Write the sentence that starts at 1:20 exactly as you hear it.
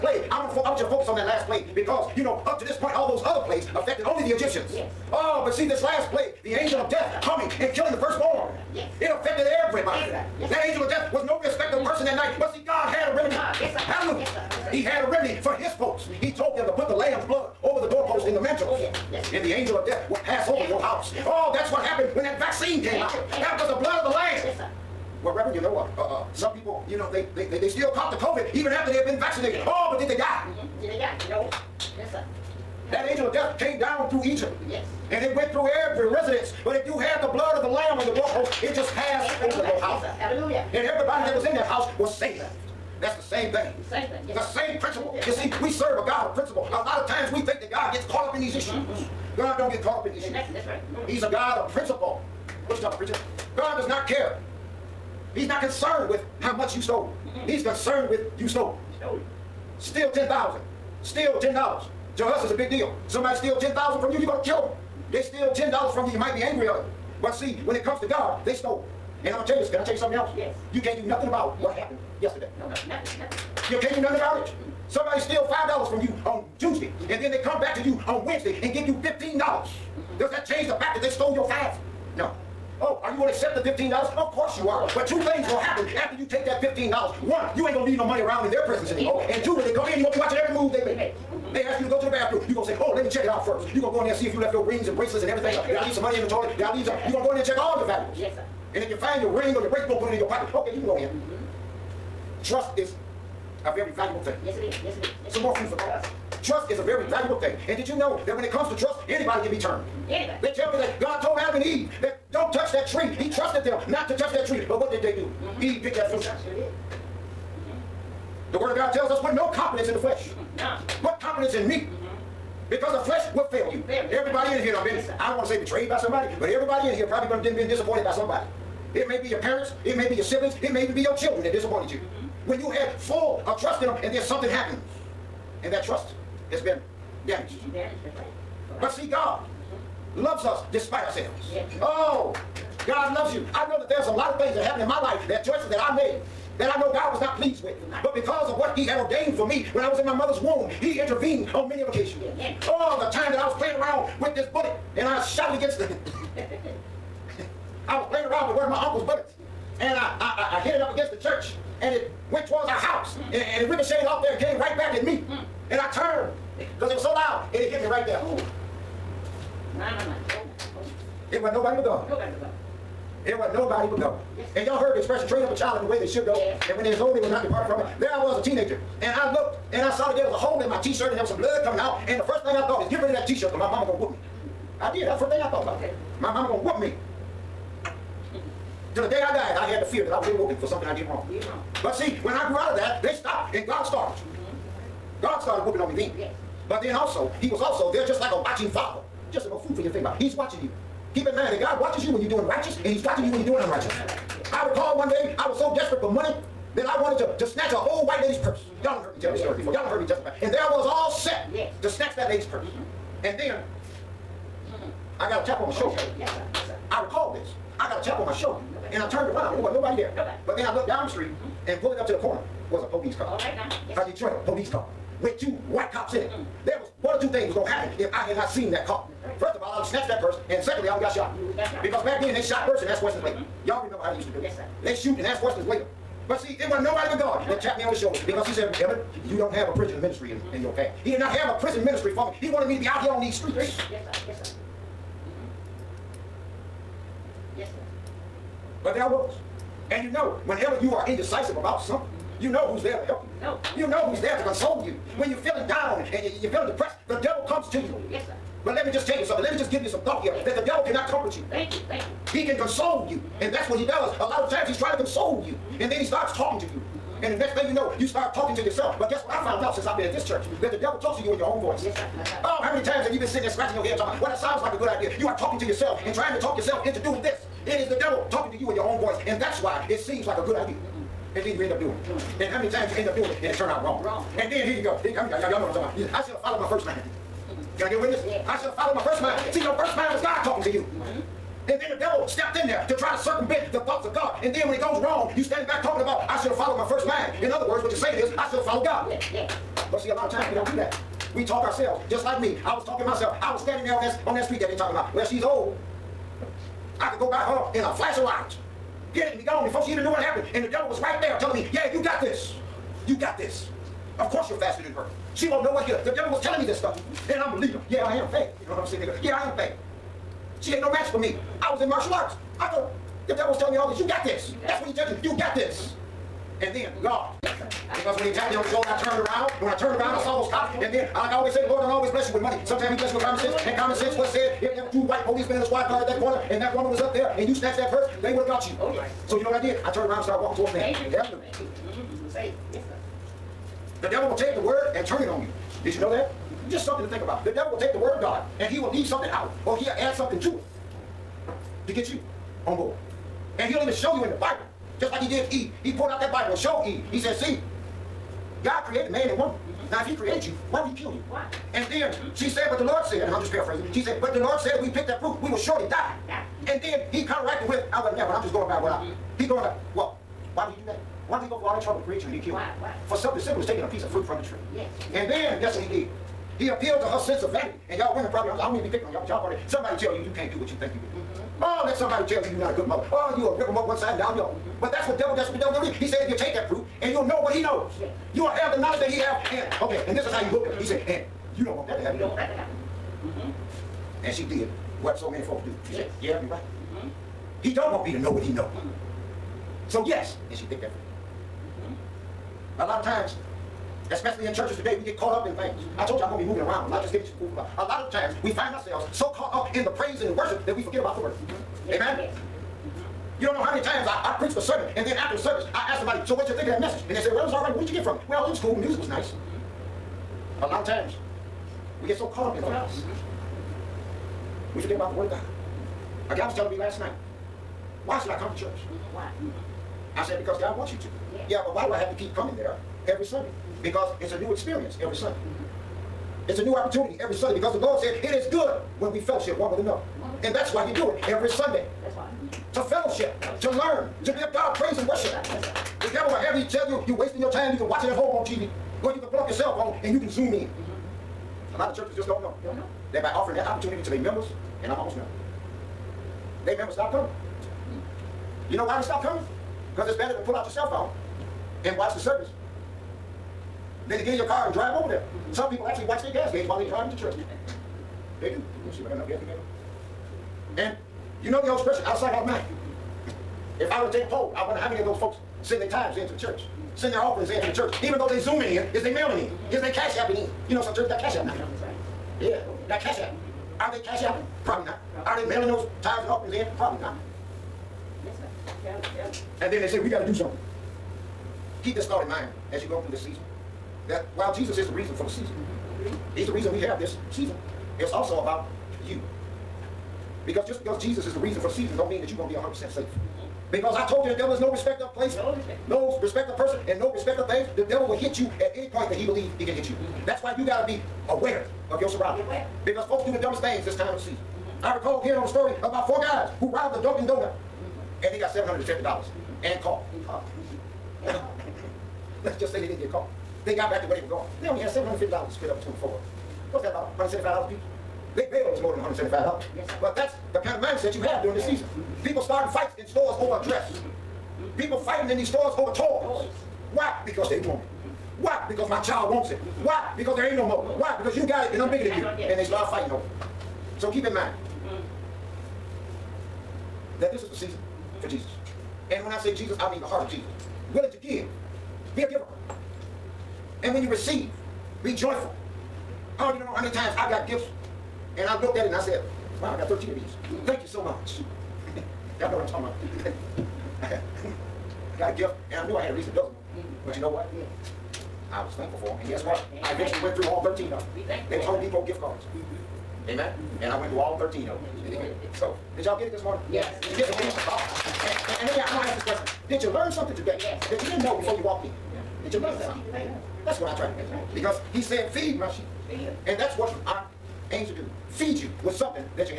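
Does that change the fact that they stole your five?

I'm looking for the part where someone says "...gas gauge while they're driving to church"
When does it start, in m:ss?
7:46.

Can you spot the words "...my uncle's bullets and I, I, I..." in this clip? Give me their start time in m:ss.
2:38.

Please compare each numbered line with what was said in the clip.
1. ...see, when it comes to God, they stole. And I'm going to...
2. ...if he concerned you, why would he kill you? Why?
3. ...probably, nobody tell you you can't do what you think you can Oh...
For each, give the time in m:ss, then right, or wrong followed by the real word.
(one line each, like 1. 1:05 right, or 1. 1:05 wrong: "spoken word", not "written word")
1. 1:07 right
2. 6:00 wrong: "created", not "concerned"
3. 6:19 wrong: "somebody", not "nobody".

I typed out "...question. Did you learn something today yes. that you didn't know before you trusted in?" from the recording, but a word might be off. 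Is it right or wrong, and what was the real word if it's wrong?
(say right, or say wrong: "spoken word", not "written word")
wrong: "walked", not "trusted".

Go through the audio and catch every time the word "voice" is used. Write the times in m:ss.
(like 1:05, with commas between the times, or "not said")
4:31, 4:39.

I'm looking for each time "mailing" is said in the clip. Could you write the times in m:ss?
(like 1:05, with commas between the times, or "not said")
7:59, 8:05.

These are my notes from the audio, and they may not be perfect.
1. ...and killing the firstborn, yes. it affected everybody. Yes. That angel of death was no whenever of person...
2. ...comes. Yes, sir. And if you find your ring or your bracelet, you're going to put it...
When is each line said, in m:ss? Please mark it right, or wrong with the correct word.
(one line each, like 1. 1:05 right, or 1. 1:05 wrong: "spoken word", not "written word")
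1. 0:07 wrong: "respecter", not "whenever"
2. 1:37 wrong: "valuables", not "comes".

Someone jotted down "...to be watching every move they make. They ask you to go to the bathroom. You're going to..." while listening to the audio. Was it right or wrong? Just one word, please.
right.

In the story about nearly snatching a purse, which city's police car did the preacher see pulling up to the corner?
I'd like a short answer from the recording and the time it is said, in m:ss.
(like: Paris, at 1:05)
Detroit, at 3:44.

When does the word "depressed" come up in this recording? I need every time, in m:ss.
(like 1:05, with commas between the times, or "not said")
4:16.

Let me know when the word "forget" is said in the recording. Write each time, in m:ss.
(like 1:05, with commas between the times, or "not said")
6:50, 7:04.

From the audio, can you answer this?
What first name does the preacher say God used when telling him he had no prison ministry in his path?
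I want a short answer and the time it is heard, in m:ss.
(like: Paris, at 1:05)
Emmett, at 3:58.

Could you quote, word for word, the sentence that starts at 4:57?
In other words, what you're saying is, I should have followed God.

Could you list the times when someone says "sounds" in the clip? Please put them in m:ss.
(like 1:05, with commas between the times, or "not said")
4:34.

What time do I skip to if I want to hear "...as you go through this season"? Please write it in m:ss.
8:12.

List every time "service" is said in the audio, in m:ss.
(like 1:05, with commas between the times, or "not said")
6:55, 7:42.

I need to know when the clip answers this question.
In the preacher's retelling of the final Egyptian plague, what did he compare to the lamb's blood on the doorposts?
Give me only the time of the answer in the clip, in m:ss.
0:22.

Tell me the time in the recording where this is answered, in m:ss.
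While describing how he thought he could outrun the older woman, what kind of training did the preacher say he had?
5:21.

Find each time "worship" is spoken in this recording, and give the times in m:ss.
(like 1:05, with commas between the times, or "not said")
6:50, 7:25.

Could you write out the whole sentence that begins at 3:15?
God started whooping on me then.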